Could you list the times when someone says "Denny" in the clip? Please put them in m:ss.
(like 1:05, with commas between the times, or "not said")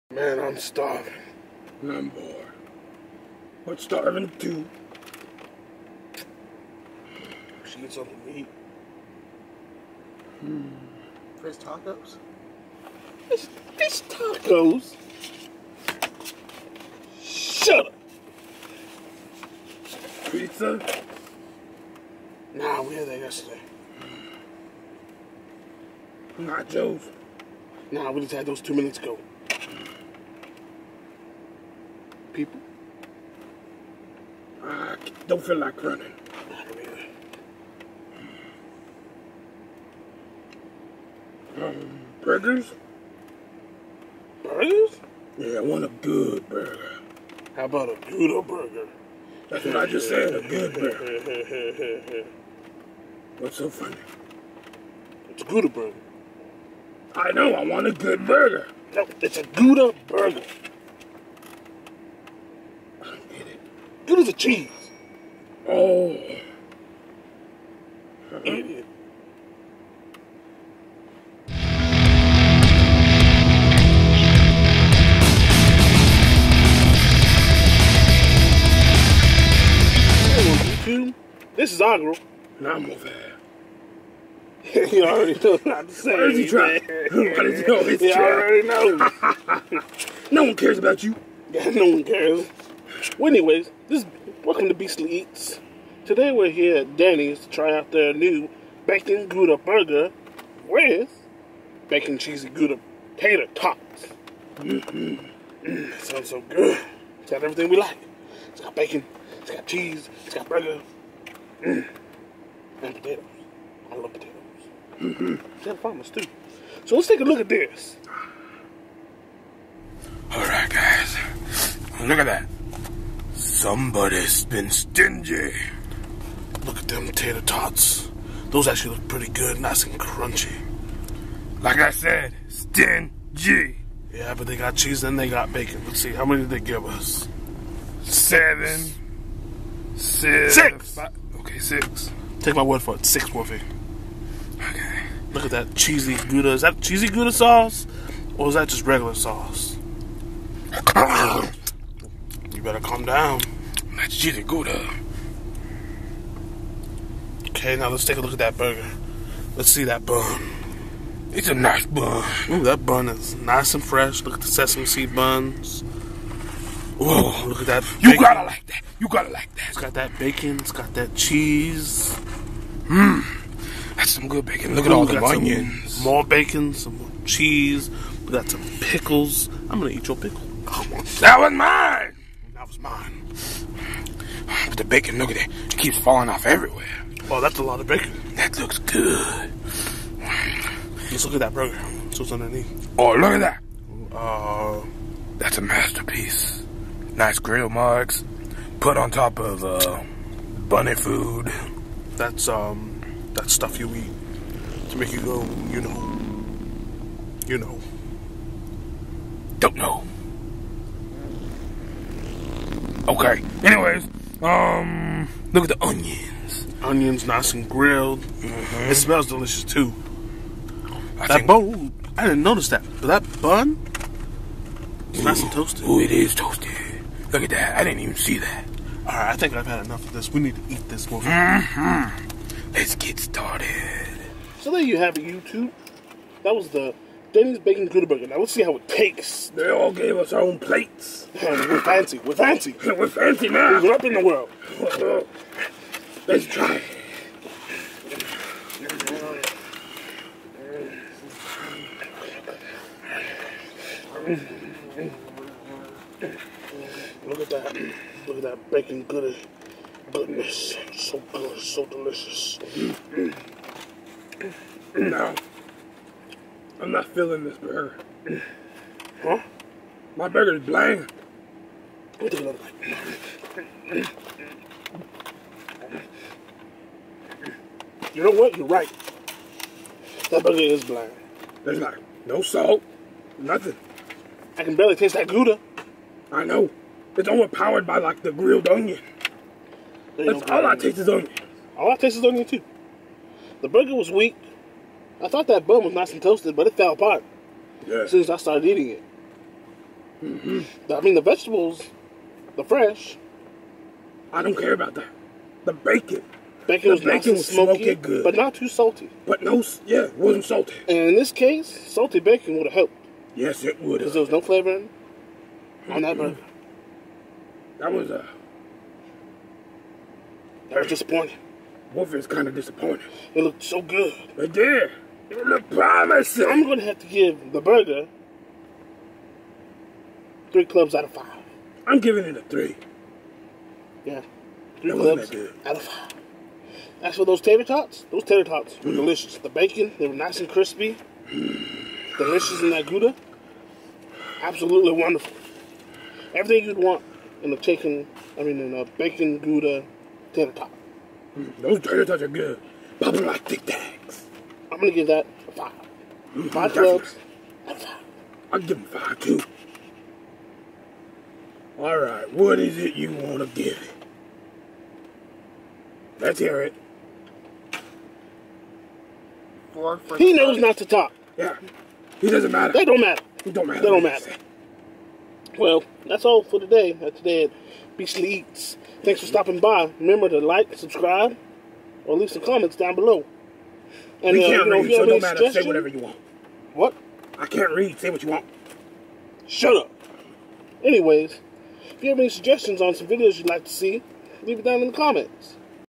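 1:36, 3:57.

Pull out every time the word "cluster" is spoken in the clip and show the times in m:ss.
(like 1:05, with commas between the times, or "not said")
not said.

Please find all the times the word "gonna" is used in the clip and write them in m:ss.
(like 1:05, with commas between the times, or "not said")
2:59, 5:26, 5:54.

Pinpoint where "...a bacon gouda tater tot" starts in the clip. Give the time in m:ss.
5:48.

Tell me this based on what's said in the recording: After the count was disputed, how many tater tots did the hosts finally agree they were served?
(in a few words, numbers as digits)
6.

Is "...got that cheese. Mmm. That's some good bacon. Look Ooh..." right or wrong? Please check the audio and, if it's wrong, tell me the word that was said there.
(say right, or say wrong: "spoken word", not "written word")
right.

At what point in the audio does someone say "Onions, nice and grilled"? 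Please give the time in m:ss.
3:36.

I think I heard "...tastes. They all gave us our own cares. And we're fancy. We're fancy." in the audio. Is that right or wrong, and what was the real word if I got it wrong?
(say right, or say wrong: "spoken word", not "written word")
wrong: "plates", not "cares".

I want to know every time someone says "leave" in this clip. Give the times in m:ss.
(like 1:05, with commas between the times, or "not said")
6:22, 6:34.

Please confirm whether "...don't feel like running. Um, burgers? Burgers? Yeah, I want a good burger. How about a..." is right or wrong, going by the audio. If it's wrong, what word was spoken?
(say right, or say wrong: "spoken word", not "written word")
right.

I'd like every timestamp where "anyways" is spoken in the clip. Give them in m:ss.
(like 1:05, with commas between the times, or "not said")
1:33, 3:33, 6:30.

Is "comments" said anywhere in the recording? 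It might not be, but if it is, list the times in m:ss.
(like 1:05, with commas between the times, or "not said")
6:22, 6:34.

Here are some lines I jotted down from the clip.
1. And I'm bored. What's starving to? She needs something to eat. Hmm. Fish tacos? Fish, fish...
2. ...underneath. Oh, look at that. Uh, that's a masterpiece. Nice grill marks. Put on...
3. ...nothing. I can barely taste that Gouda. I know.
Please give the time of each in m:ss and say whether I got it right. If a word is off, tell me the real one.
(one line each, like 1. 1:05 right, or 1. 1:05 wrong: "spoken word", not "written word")
1. 0:01 right
2. 3:12 right
3. 4:43 right.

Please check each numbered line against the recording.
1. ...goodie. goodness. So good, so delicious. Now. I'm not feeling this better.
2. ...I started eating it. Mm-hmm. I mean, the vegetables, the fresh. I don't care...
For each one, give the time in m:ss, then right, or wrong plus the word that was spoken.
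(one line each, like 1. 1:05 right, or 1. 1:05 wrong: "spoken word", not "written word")
1. 4:19 wrong: "burger", not "better"
2. 4:58 right.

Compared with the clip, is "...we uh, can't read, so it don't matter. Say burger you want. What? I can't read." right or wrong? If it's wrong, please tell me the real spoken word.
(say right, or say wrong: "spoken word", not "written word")
wrong: "whatever", not "burger".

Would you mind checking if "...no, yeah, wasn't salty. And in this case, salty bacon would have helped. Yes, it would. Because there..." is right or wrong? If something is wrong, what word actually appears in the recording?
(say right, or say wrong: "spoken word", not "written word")
right.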